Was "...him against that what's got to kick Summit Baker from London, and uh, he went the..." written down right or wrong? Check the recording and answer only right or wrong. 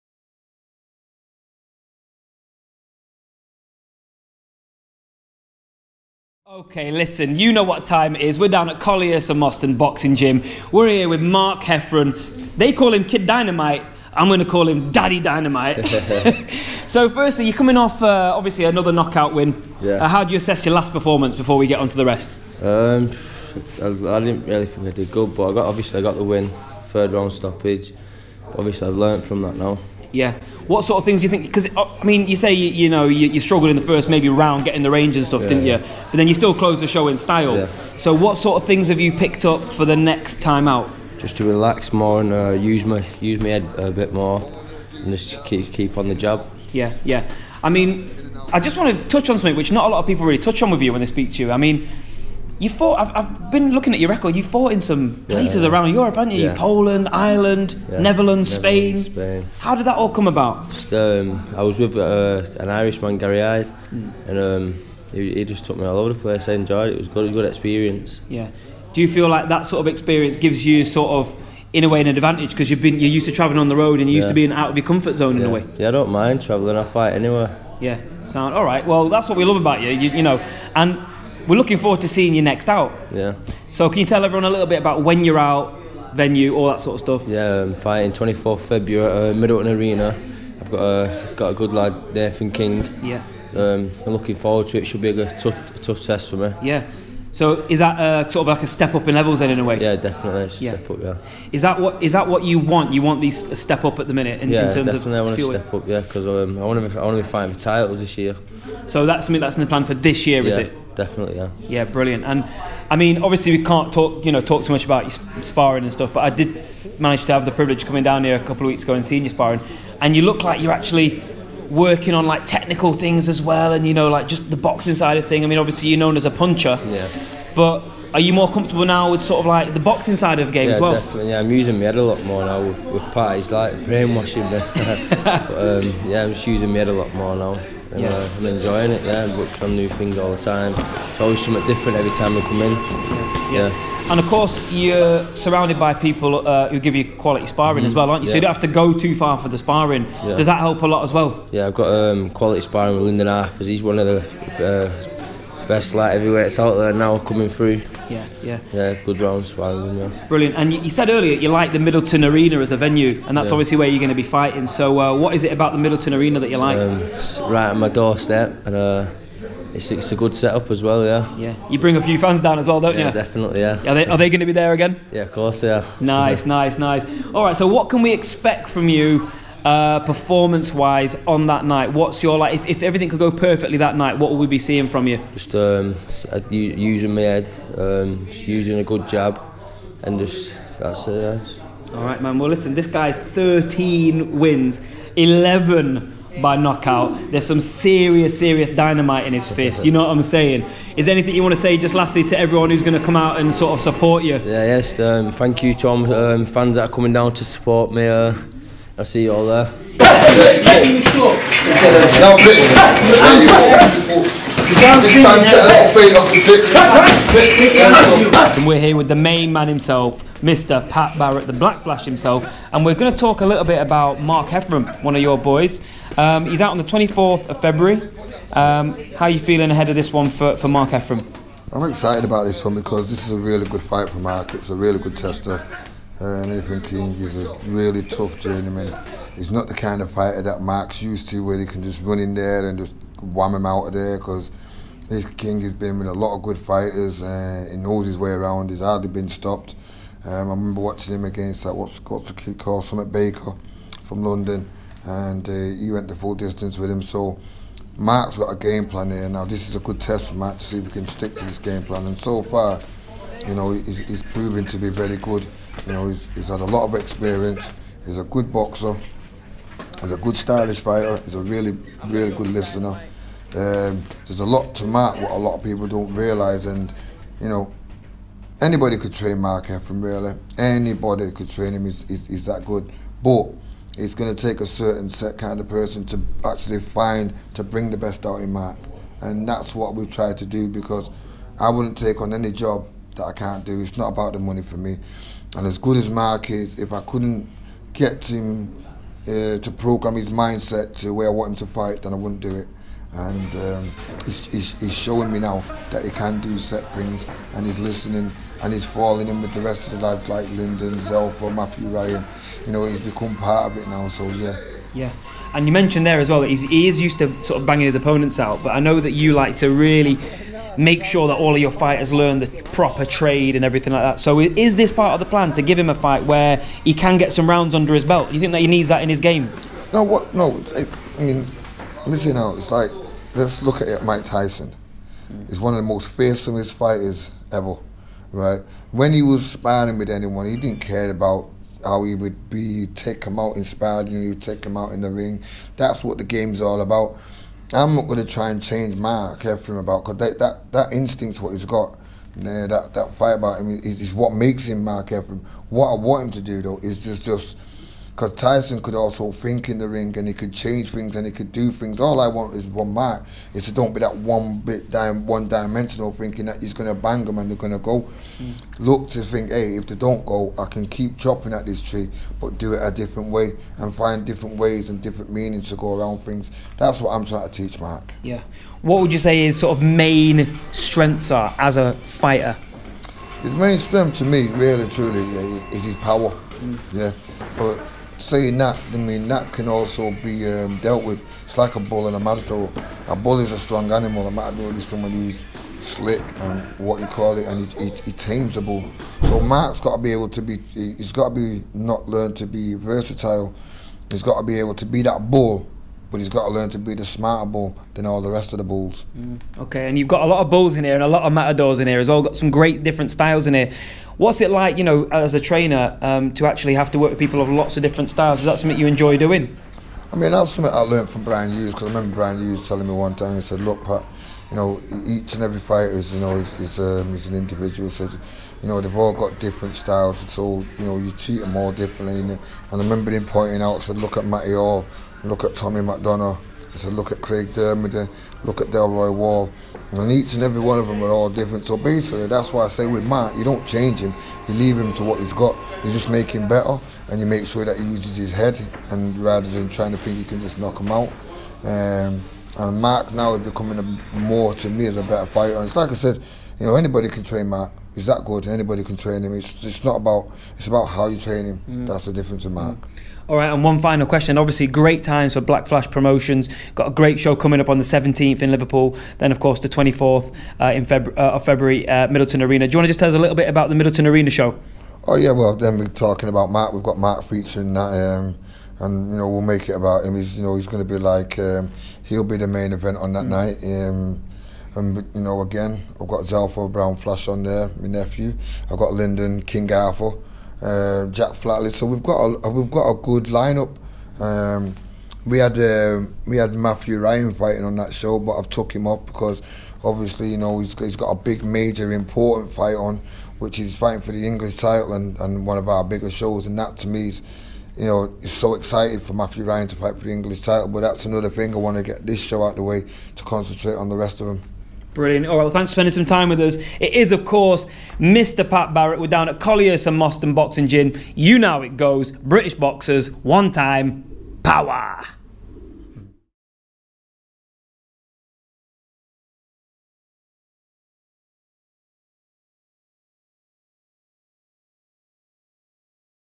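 right.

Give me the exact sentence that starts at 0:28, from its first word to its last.
Obviously, I've learnt from that now.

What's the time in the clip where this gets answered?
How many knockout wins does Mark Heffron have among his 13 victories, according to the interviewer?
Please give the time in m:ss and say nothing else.
3:15.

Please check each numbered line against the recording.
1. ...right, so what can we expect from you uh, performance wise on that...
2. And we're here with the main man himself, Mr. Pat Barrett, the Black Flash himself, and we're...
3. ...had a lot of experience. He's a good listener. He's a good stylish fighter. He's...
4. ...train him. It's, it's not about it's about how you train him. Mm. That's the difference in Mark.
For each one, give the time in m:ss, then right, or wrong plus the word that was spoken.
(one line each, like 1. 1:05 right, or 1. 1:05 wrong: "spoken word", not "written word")
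1. 2:57 right
2. 3:29 right
3. 4:26 wrong: "boxer", not "listener"
4. 7:38 right.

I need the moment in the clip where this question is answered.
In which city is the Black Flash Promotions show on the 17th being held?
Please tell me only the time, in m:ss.
7:48.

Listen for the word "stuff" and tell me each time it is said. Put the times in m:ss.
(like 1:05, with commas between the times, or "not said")
0:35, 1:27, 1:55.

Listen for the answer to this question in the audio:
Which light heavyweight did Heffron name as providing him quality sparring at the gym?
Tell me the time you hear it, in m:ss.
2:33.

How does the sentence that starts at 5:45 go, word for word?
That's what the game's all about.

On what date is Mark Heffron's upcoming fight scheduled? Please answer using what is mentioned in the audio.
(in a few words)
24th February.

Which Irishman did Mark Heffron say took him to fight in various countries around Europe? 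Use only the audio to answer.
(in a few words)
Gary Hyde.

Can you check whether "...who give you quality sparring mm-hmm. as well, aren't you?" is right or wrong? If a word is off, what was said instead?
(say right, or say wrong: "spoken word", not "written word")
right.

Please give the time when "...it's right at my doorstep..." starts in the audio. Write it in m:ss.
2:47.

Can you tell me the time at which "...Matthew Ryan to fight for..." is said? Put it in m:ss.
8:29.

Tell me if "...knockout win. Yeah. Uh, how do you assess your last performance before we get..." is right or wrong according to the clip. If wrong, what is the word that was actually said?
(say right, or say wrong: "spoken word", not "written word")
right.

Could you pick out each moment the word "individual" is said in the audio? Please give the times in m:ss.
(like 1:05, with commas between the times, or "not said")
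7:07.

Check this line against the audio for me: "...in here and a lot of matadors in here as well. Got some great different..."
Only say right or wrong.
right.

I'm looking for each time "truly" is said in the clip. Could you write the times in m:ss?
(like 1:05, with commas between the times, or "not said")
6:24.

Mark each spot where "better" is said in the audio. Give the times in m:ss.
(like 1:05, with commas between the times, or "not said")
7:26, 7:35.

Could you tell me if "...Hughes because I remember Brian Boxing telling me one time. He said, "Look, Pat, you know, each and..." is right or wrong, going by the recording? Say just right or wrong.
wrong.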